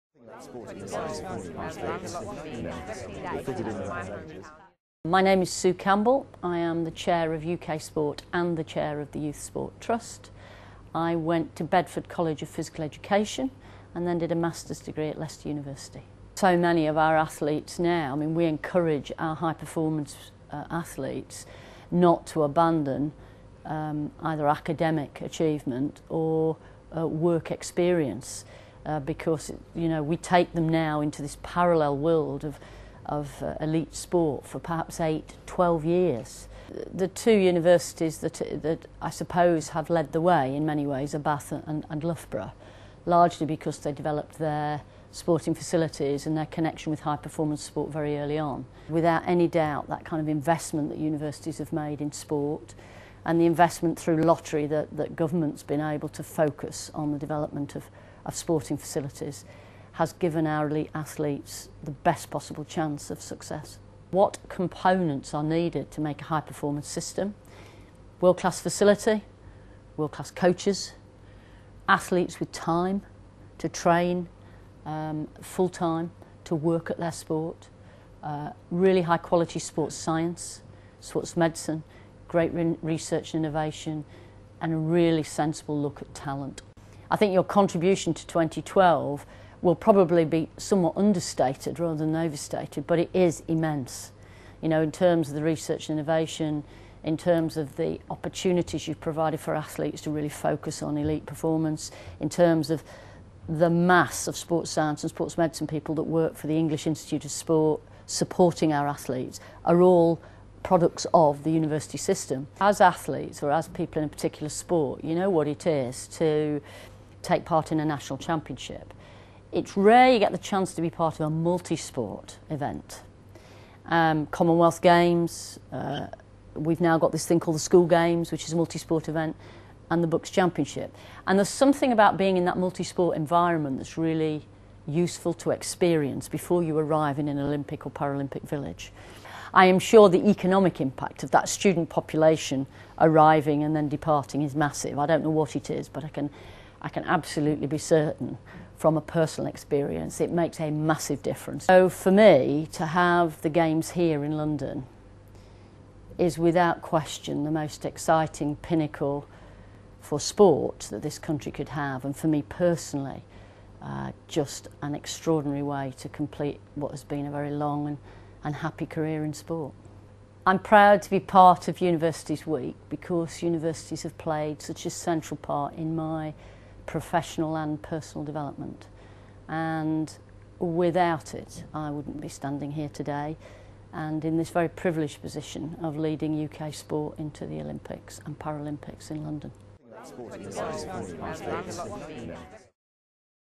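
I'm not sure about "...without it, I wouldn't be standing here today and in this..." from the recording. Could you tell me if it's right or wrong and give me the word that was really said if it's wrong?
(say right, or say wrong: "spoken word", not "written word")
right.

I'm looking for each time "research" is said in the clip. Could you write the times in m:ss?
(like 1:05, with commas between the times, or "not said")
1:22, 1:35.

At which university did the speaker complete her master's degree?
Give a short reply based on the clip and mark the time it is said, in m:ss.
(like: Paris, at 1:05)
Leicester University, at 0:15.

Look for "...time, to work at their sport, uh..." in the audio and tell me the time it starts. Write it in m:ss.
1:15.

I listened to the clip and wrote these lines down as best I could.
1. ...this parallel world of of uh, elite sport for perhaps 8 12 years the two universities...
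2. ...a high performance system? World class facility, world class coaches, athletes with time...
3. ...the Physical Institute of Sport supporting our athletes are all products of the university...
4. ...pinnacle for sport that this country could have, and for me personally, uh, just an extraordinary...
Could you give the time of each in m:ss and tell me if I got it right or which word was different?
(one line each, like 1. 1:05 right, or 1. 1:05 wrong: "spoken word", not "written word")
1. 0:31 right
2. 1:06 right
3. 1:46 wrong: "English", not "Physical"
4. 2:38 right.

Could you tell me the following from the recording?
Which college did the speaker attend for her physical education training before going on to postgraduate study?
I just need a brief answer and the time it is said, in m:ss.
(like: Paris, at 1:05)
Bedford College of Physical Education, at 0:11.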